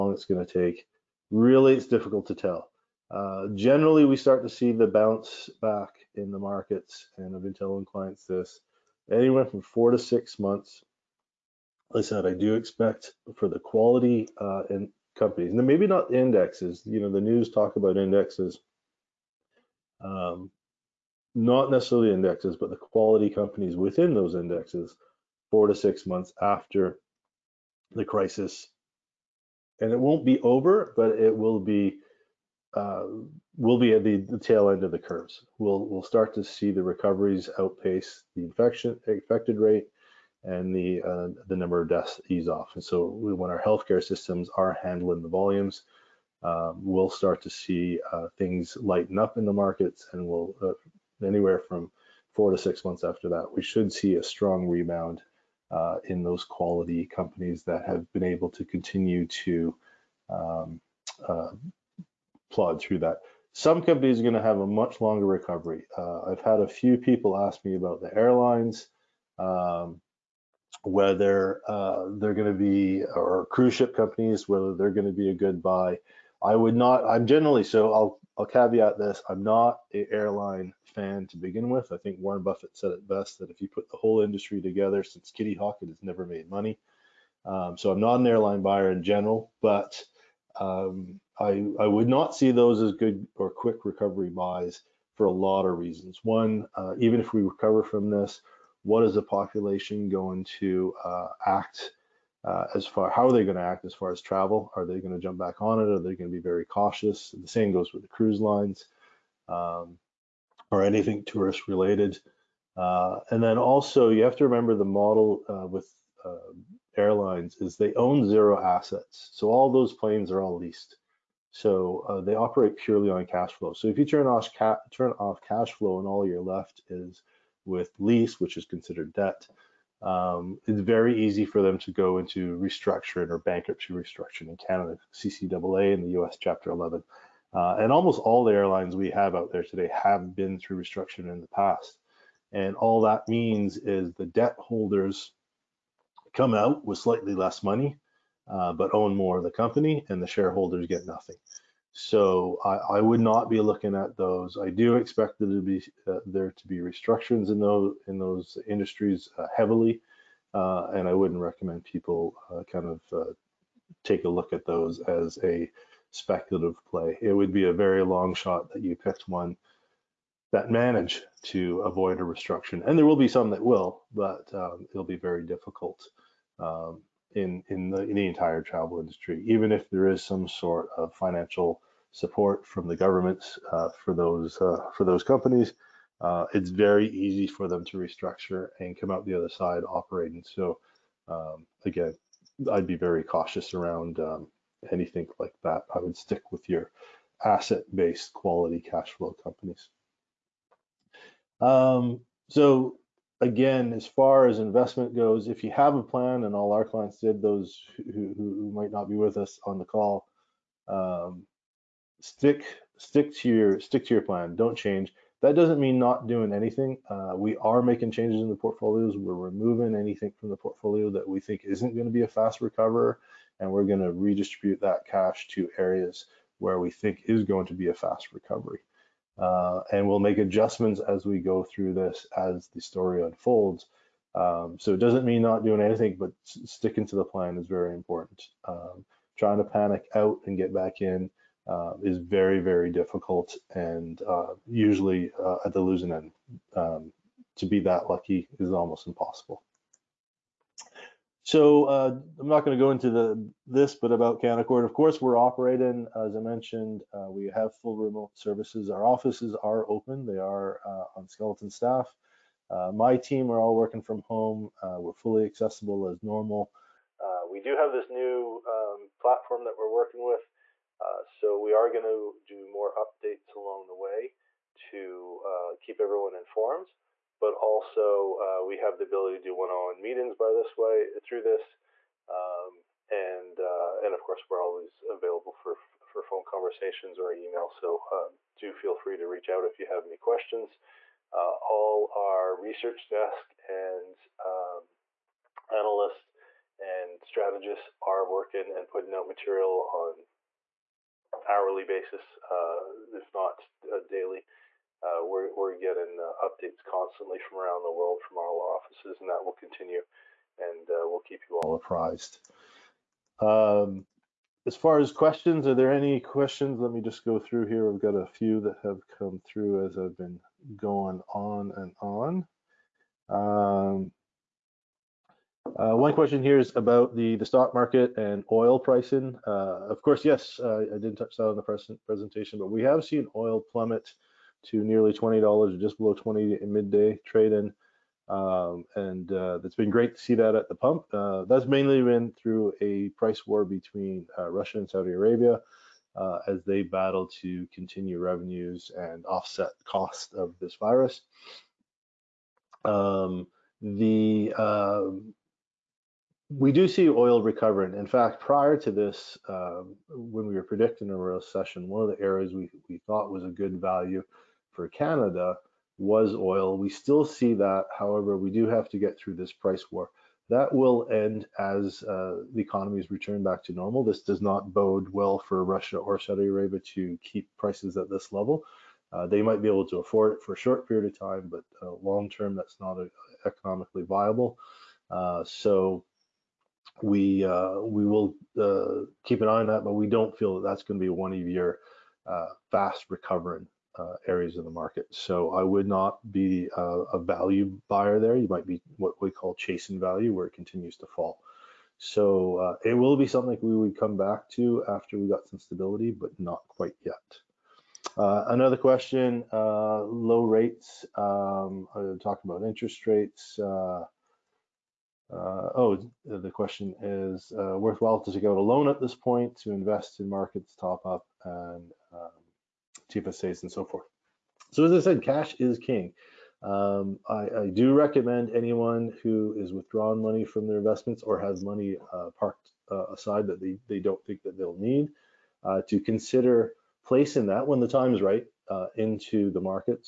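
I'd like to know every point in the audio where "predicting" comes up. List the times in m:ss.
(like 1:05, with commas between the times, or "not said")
6:00.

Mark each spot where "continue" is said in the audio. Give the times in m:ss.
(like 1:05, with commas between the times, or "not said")
0:58, 5:09, 5:47, 6:40.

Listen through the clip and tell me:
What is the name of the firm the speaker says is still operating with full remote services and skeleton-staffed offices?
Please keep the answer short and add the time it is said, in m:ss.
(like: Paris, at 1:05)
Canaccord, at 4:14.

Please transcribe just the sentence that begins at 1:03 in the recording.
Some companies are going to have a much longer recovery.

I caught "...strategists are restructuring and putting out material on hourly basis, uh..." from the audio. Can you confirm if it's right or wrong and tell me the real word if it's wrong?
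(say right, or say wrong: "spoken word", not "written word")
wrong: "working", not "restructuring".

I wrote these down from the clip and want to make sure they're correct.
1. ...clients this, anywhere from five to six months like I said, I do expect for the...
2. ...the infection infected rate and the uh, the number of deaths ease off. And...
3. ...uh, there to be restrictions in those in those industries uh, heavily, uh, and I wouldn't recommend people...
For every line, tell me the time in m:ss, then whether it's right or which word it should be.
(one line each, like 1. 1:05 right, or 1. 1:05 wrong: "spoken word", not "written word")
1. 0:07 wrong: "four", not "five"
2. 0:38 right
3. 2:36 right.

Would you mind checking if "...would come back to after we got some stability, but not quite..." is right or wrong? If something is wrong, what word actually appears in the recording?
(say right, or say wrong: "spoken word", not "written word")
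right.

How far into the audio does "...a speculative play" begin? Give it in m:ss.
2:45.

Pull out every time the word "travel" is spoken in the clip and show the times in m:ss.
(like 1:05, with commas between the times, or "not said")
1:44, 2:58.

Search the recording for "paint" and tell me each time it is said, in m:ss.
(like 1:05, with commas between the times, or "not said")
not said.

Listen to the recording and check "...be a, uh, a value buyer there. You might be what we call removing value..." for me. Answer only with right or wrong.
wrong.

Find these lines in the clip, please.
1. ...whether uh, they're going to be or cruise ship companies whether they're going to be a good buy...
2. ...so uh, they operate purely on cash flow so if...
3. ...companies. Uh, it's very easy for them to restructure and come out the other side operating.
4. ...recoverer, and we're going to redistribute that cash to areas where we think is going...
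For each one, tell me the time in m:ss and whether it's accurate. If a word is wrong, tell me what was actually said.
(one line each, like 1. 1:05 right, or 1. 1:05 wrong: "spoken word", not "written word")
1. 1:10 right
2. 2:01 right
3. 3:05 right
4. 3:42 right.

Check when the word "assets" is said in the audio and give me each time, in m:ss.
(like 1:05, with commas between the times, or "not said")
1:58, 3:17.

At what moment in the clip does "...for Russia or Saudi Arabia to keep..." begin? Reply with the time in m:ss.
6:15.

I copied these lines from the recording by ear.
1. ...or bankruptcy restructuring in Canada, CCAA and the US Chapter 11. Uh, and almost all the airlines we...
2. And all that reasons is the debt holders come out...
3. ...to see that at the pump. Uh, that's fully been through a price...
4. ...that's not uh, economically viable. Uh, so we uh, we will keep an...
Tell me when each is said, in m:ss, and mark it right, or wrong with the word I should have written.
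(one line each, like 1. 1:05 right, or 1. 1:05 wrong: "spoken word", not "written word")
1. 2:13 right
2. 2:22 wrong: "means", not "reasons"
3. 5:40 wrong: "mainly", not "fully"
4. 6:22 right.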